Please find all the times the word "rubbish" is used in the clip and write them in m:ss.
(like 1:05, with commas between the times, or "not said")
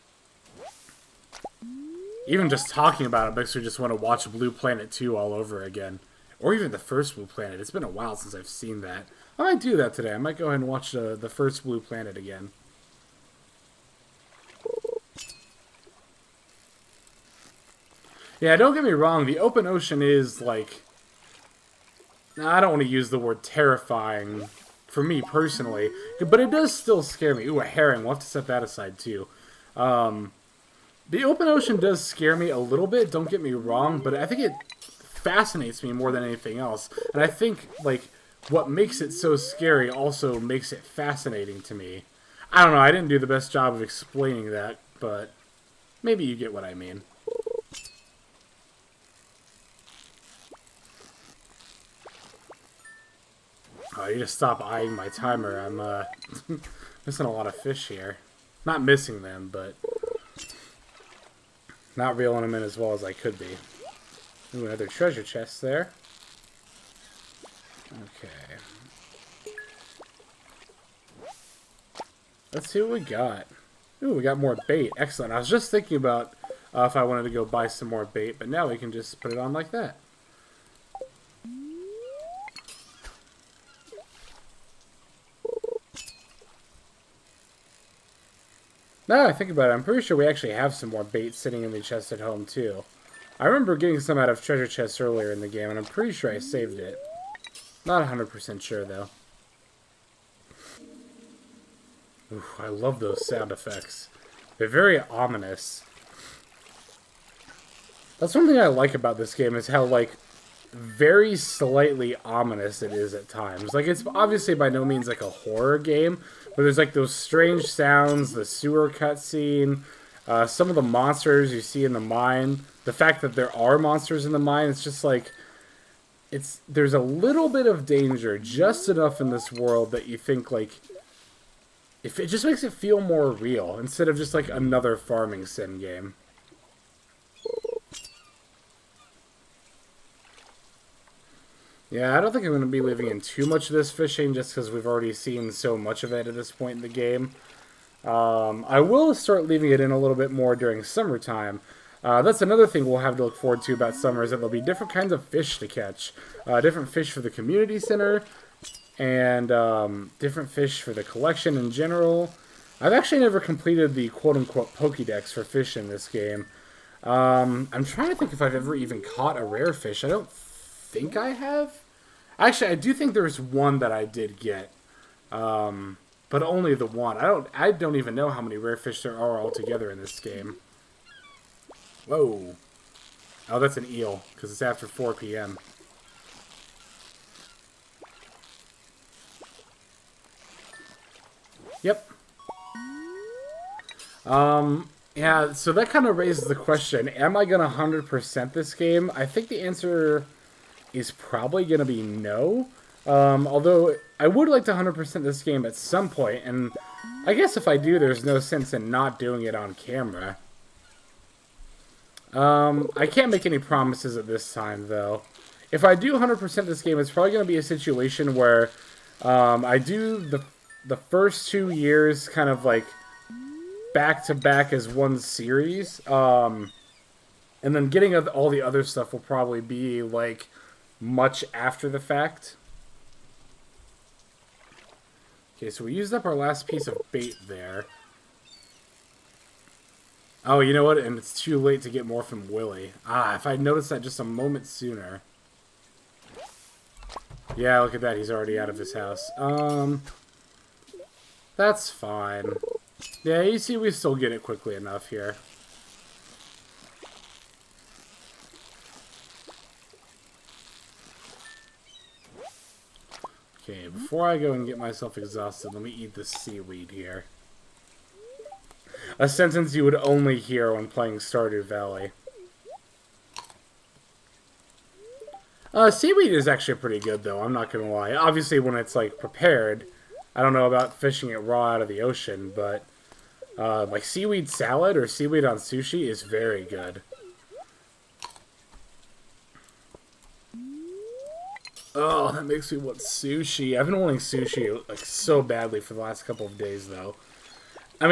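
not said.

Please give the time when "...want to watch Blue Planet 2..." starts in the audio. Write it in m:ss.
0:03.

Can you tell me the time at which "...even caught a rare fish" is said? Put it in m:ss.
2:48.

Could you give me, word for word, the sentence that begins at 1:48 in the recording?
That's one thing I like about this game is how, like, very slightly ominous it is at times.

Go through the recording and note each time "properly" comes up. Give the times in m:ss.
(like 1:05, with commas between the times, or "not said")
not said.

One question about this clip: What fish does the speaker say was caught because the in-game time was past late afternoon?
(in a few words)
Eel.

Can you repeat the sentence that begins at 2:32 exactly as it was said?
Uh, that's another thing we'll have to look forward to about summer is that there'll be different kinds of fish to catch.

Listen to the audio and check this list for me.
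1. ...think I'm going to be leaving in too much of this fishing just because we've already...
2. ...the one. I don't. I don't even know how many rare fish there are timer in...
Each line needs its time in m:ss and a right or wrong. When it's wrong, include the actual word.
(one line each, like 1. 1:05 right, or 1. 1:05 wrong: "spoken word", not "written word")
1. 2:22 right
2. 2:56 wrong: "altogether", not "timer".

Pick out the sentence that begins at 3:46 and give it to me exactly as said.
Um, and then getting all the other stuff will probably be like much after the fact.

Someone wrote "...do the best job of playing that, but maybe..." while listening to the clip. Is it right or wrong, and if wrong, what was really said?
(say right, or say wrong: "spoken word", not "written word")
wrong: "explaining", not "playing".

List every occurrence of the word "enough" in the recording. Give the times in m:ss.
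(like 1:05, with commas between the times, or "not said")
2:08, 4:14.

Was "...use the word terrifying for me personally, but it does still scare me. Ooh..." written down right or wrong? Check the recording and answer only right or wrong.
right.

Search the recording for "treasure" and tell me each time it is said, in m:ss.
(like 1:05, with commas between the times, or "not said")
1:04, 1:34.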